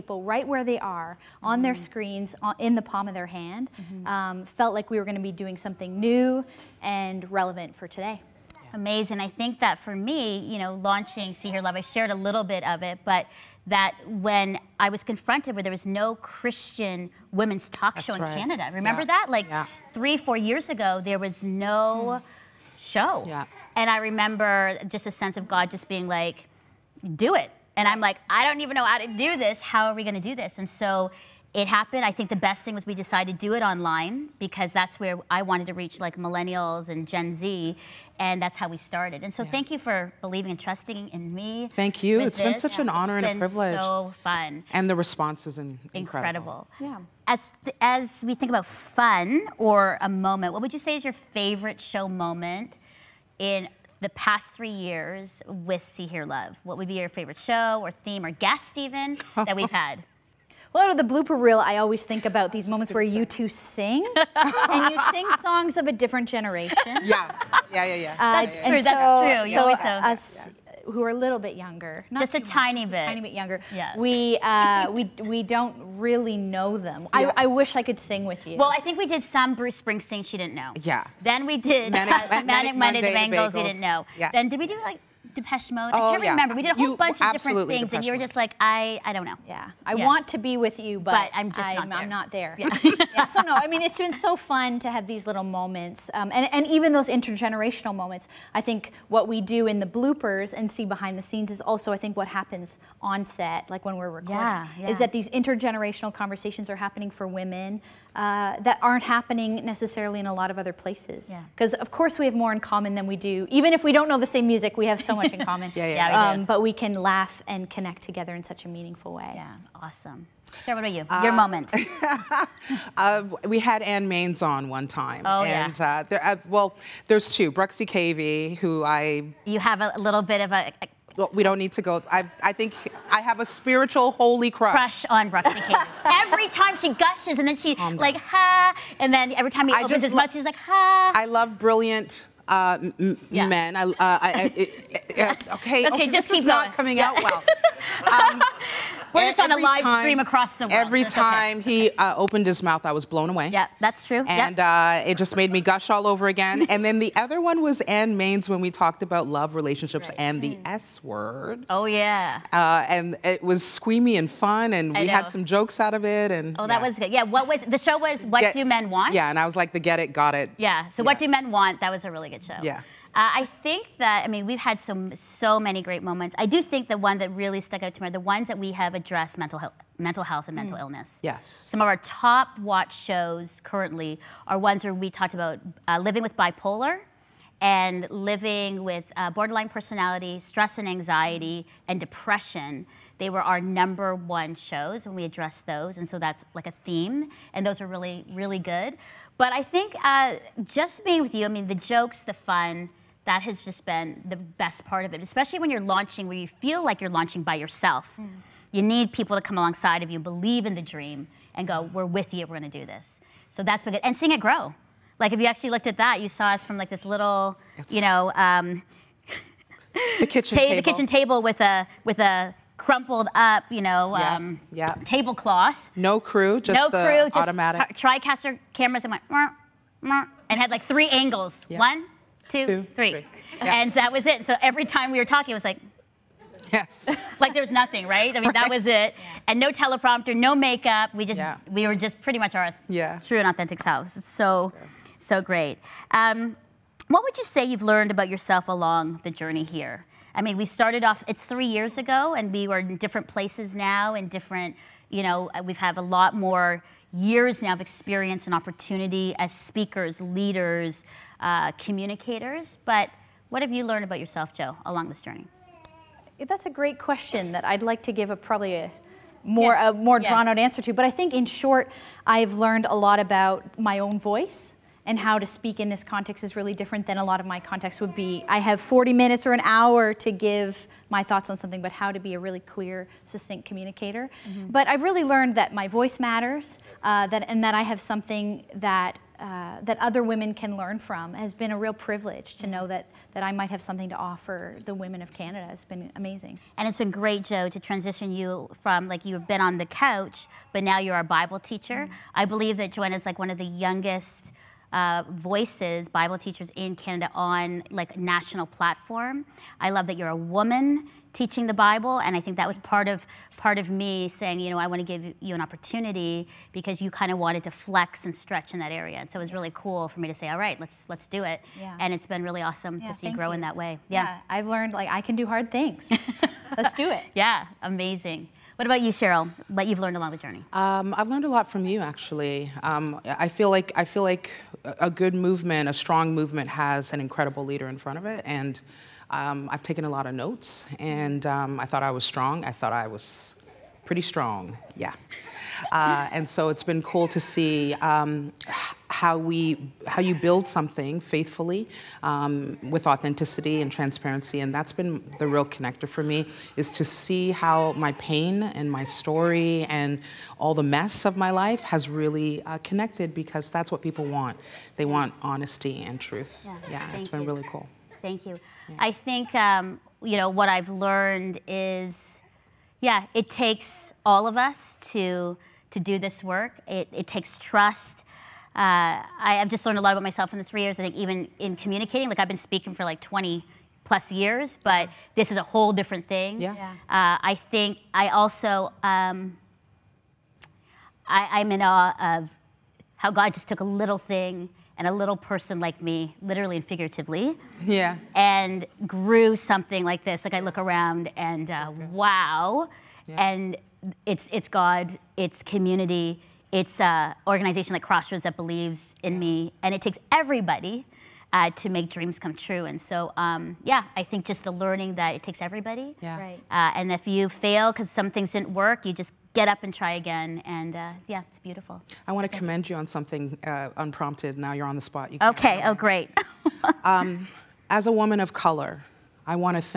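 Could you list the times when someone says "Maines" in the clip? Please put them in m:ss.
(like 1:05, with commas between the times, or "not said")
2:04, 2:38.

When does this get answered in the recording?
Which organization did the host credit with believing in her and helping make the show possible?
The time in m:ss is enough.
6:48.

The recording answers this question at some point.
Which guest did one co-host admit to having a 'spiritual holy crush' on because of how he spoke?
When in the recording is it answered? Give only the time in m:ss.
2:07.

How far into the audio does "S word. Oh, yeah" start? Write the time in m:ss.
2:40.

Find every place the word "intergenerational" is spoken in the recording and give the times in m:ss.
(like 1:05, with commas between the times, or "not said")
1:37, 1:45.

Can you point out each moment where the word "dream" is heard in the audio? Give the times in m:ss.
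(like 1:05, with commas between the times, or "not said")
3:30, 6:52.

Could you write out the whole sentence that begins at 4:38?
I have 40 minutes or an hour to give my thoughts on something, but how to be a really clear, succinct communicator.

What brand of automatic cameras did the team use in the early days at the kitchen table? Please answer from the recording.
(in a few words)
Tricaster.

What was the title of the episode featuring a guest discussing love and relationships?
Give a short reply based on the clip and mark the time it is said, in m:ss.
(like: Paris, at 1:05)
What Do Men Want?, at 2:51.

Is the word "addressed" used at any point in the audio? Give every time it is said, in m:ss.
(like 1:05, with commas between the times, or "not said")
2:58, 3:15.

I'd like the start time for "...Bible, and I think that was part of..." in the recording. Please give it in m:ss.
5:11.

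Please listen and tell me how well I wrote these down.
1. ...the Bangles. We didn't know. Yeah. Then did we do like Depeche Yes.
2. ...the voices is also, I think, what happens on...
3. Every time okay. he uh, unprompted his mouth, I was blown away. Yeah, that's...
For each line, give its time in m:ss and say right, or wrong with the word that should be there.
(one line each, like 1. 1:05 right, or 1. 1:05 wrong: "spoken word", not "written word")
1. 1:23 wrong: "Mode", not "Yes"
2. 1:41 wrong: "scenes", not "voices"
3. 2:30 wrong: "opened", not "unprompted".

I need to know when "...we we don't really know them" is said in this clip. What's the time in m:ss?
1:14.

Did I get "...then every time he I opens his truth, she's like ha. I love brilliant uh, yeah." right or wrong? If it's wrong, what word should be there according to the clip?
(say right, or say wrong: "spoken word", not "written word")
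wrong: "mouth", not "truth".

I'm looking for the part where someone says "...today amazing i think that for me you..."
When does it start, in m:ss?
0:07.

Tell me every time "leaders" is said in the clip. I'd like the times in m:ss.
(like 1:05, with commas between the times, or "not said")
4:20, 5:37.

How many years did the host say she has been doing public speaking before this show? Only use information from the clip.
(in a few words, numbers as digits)
20 plus.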